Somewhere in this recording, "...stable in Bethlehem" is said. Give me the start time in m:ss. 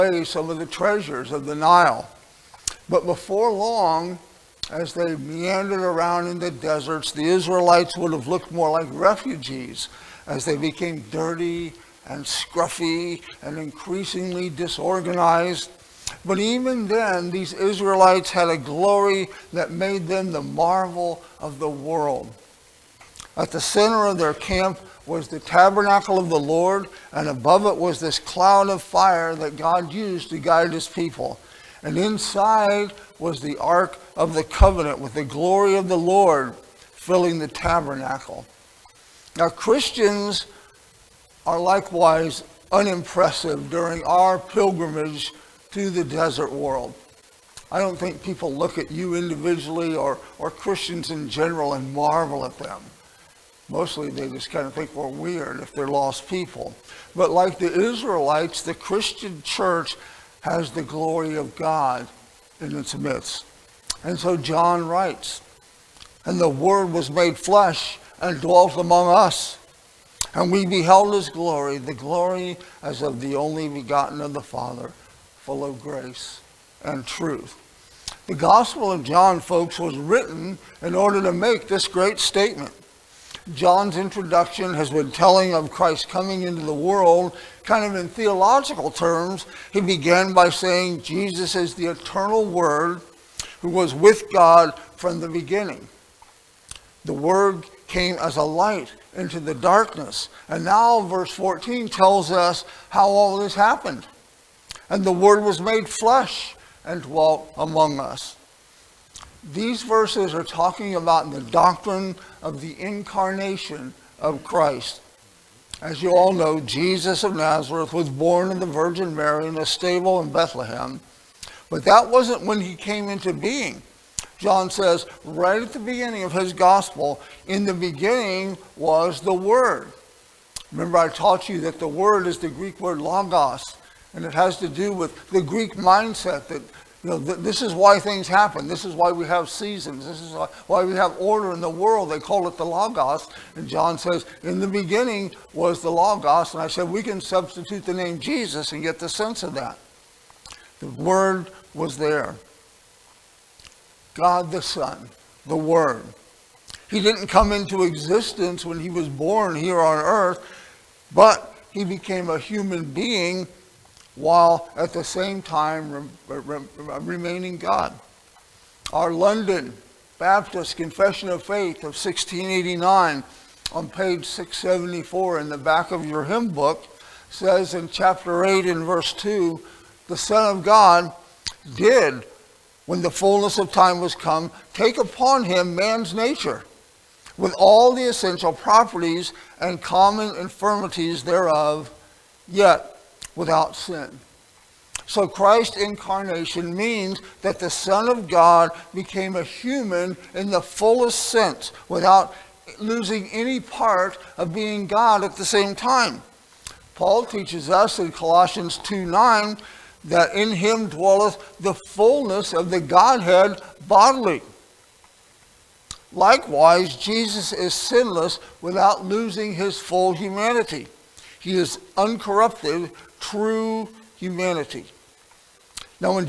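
1:59.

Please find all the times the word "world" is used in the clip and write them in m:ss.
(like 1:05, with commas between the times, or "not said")
0:21, 0:46, 1:26, 2:21.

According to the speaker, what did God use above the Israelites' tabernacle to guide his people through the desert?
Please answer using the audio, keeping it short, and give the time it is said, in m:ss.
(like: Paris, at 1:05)
cloud of fire, at 0:28.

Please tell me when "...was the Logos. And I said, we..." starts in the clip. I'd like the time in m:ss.
2:25.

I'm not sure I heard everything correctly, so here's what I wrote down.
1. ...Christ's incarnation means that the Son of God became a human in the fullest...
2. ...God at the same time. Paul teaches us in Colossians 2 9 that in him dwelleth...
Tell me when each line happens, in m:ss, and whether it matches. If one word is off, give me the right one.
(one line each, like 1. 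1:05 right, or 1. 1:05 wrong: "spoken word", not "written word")
1. 3:15 right
2. 3:24 right.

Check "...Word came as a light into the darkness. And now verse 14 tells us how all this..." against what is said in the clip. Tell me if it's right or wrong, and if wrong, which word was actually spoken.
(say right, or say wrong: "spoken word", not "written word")
right.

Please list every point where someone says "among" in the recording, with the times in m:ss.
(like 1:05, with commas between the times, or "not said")
1:08, 1:47.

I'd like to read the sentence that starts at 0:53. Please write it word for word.
Mostly they just kind of think we're weird if they're lost people.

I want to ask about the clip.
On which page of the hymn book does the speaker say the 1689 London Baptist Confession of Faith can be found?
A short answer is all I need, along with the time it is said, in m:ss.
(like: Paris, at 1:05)
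674, at 2:54.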